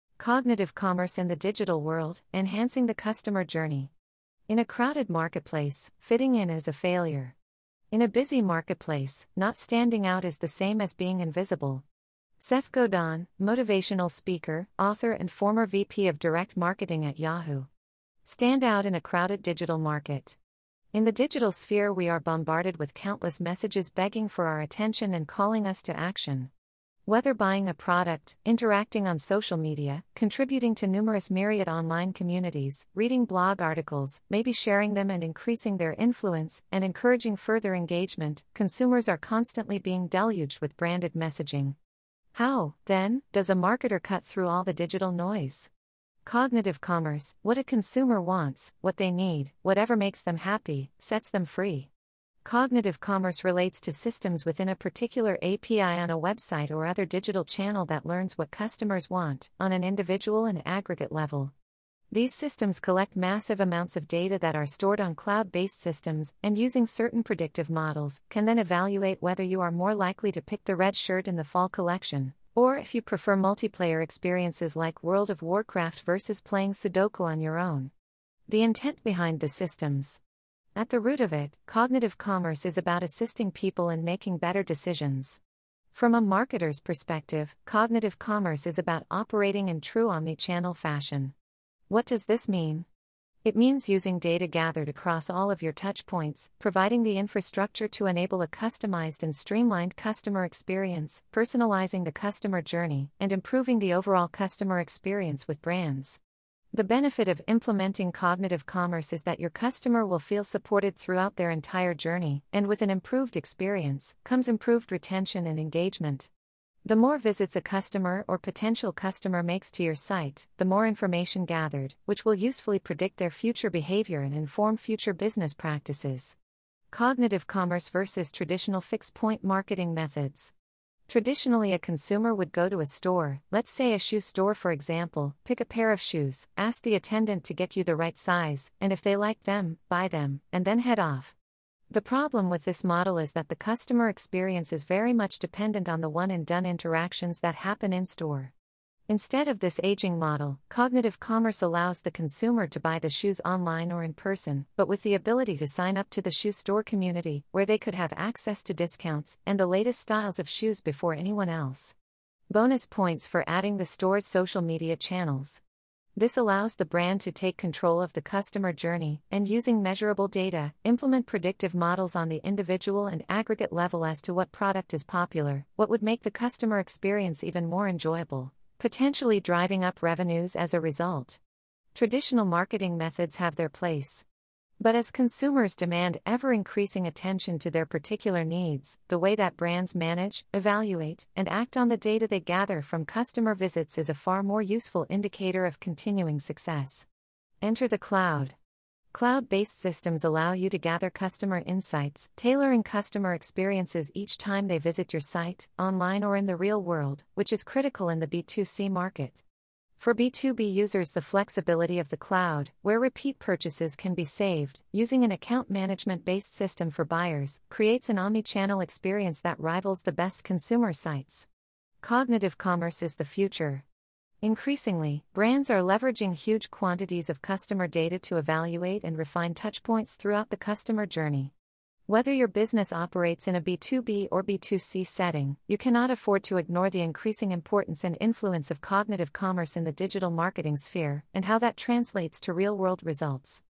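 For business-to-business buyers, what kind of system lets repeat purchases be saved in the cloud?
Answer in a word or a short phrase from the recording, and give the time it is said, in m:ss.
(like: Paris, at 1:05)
Account management based system, at 3:35.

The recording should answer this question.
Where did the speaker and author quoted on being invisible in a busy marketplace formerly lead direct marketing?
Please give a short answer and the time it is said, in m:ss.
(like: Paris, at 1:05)
Yahoo, at 0:17.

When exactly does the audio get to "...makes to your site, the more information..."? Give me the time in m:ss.
1:59.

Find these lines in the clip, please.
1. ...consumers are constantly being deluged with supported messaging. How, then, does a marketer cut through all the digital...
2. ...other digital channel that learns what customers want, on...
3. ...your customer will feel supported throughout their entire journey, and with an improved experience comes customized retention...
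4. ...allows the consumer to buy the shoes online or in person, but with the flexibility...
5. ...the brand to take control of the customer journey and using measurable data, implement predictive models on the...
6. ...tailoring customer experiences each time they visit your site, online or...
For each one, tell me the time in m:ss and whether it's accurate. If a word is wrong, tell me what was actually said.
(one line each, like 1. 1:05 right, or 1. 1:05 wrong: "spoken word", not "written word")
1. 0:38 wrong: "branded", not "supported"
2. 0:56 right
3. 1:49 wrong: "improved", not "customized"
4. 2:31 wrong: "ability", not "flexibility"
5. 2:46 right
6. 3:22 right.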